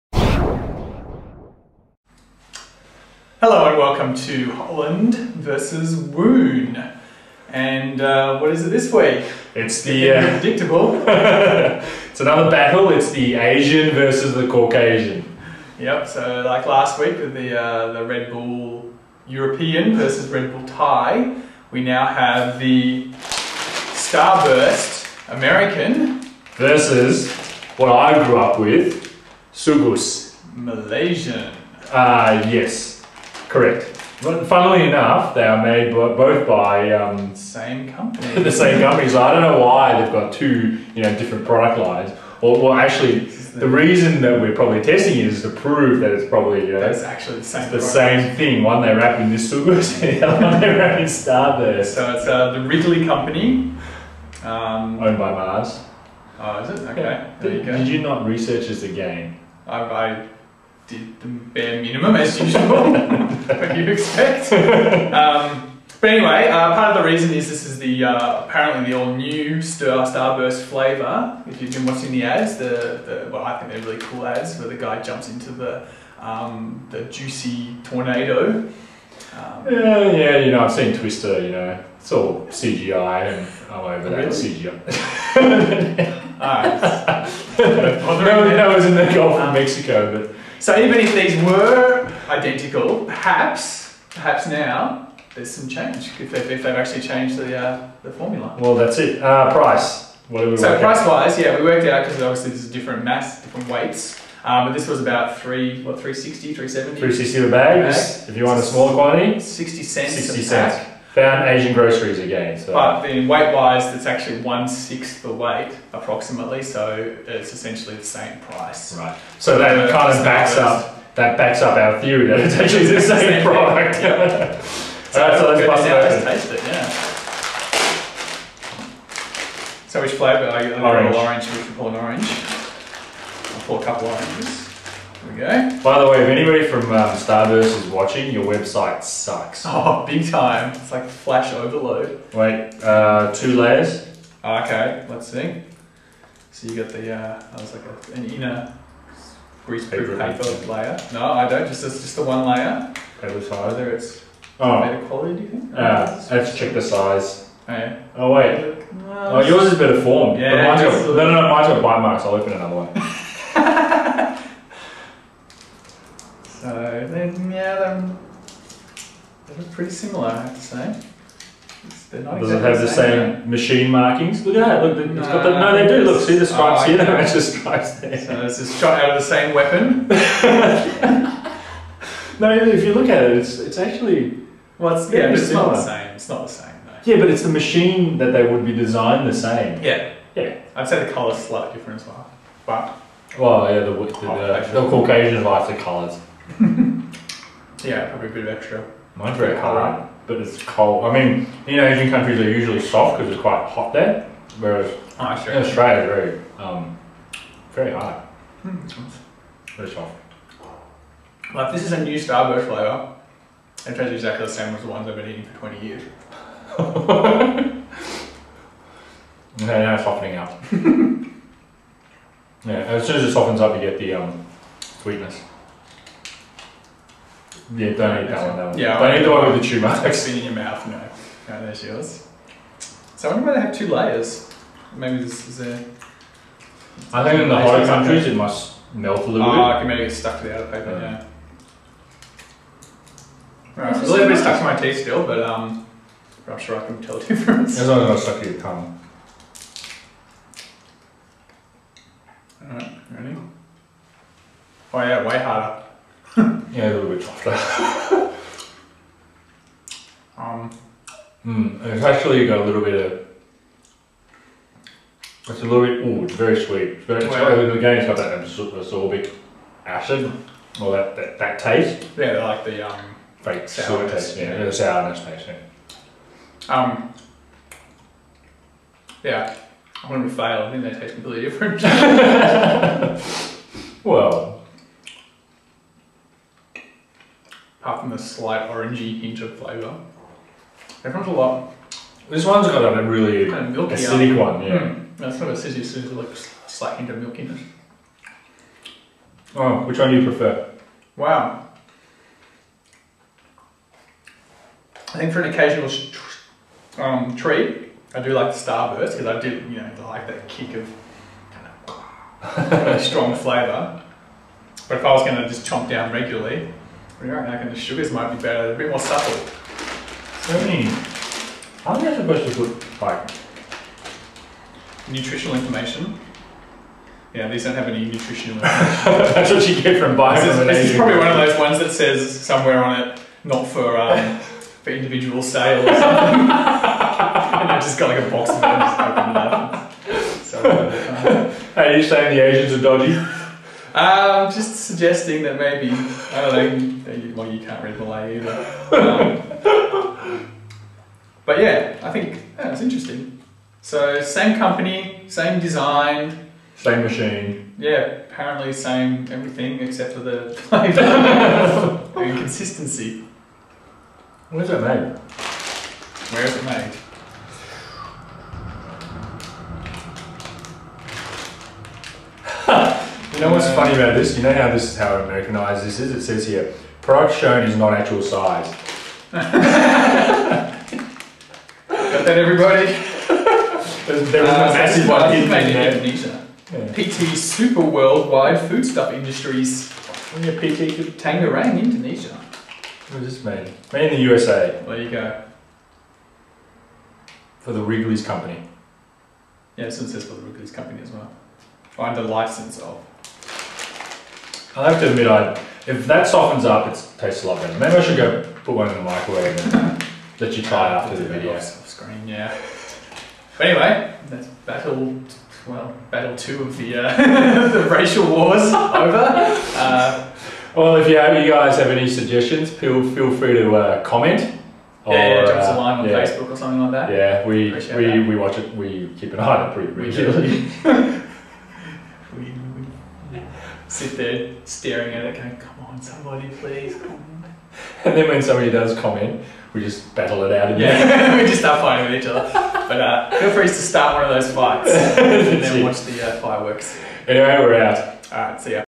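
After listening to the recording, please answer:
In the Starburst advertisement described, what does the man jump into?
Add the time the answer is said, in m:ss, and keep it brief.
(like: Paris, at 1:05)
the juicy tornado, at 1:16.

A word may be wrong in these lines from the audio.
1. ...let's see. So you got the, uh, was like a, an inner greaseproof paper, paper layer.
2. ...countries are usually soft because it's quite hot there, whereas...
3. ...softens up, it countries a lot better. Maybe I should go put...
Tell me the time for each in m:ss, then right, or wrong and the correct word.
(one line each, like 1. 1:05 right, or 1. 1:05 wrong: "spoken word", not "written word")
1. 2:25 right
2. 3:22 right
3. 6:46 wrong: "tastes", not "countries".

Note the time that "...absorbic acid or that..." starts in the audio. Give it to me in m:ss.
4:28.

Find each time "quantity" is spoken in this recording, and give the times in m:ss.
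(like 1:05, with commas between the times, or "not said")
1:48.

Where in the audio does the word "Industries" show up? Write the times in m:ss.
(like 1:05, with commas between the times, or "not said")
6:29.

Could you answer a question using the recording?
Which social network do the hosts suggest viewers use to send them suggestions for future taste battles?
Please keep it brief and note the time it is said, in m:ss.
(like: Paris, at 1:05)
Facebook, at 7:06.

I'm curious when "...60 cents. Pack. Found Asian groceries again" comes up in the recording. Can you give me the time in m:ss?
1:50.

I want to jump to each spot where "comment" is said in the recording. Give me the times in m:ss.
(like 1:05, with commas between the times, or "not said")
7:04, 7:18.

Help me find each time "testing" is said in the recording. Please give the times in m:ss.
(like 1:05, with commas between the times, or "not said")
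0:44.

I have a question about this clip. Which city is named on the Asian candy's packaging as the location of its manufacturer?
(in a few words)
Tangerang.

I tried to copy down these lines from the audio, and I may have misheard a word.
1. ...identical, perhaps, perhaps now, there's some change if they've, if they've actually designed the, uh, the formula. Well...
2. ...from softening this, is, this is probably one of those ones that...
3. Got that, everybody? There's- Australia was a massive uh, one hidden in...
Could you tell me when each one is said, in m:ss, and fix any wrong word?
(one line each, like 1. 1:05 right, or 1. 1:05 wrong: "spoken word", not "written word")
1. 1:32 wrong: "changed", not "designed"
2. 5:30 wrong: "buying", not "softening"
3. 6:19 wrong: "There", not "Australia".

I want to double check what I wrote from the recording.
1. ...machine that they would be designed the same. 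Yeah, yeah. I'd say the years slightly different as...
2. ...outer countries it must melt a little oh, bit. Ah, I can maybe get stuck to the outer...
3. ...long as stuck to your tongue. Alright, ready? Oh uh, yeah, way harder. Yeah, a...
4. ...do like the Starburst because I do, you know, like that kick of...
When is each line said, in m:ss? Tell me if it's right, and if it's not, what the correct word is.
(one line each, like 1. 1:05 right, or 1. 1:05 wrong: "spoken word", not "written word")
1. 3:07 wrong: "colours", not "years"
2. 3:57 wrong: "hotter", not "outer"
3. 4:07 right
4. 5:08 right.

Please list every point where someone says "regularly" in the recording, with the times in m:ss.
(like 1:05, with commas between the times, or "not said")
5:16, 7:09.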